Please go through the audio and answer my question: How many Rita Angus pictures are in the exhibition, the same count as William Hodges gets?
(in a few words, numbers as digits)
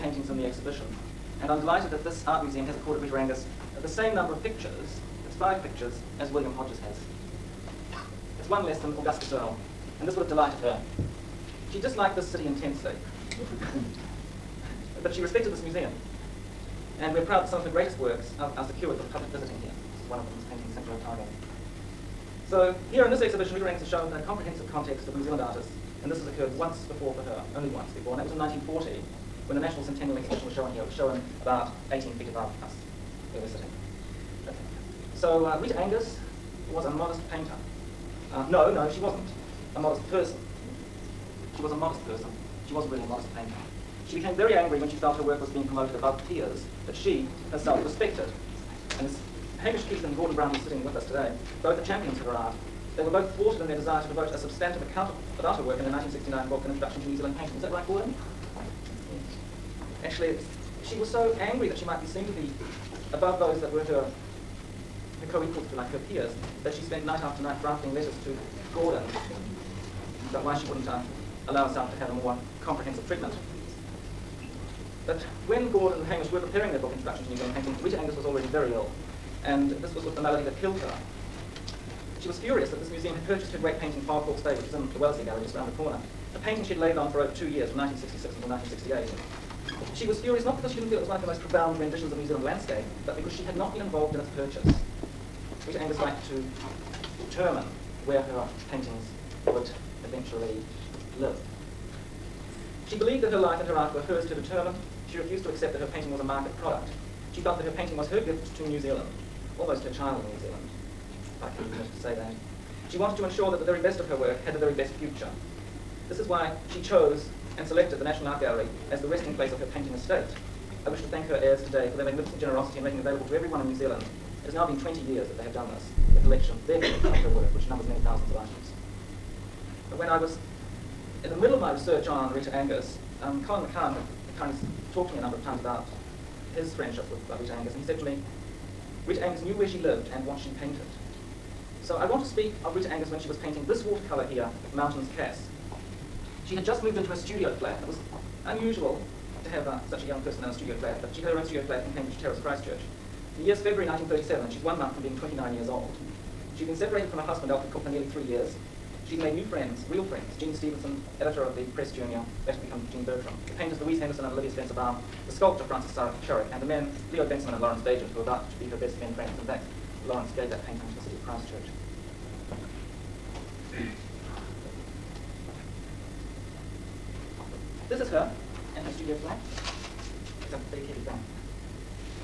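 5.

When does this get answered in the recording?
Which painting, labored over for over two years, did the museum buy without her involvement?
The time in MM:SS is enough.
01:24.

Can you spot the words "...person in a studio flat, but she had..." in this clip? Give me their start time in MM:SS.
02:30.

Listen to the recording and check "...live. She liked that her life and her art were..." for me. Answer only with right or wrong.
wrong.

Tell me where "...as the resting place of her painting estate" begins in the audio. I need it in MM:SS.
01:58.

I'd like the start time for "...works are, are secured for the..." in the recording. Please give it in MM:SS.
00:17.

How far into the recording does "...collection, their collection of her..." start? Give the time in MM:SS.
02:06.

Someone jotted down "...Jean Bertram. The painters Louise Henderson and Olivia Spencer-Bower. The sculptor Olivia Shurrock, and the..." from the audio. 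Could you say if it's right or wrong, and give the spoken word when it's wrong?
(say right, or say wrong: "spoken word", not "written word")
wrong: "Francis", not "Olivia".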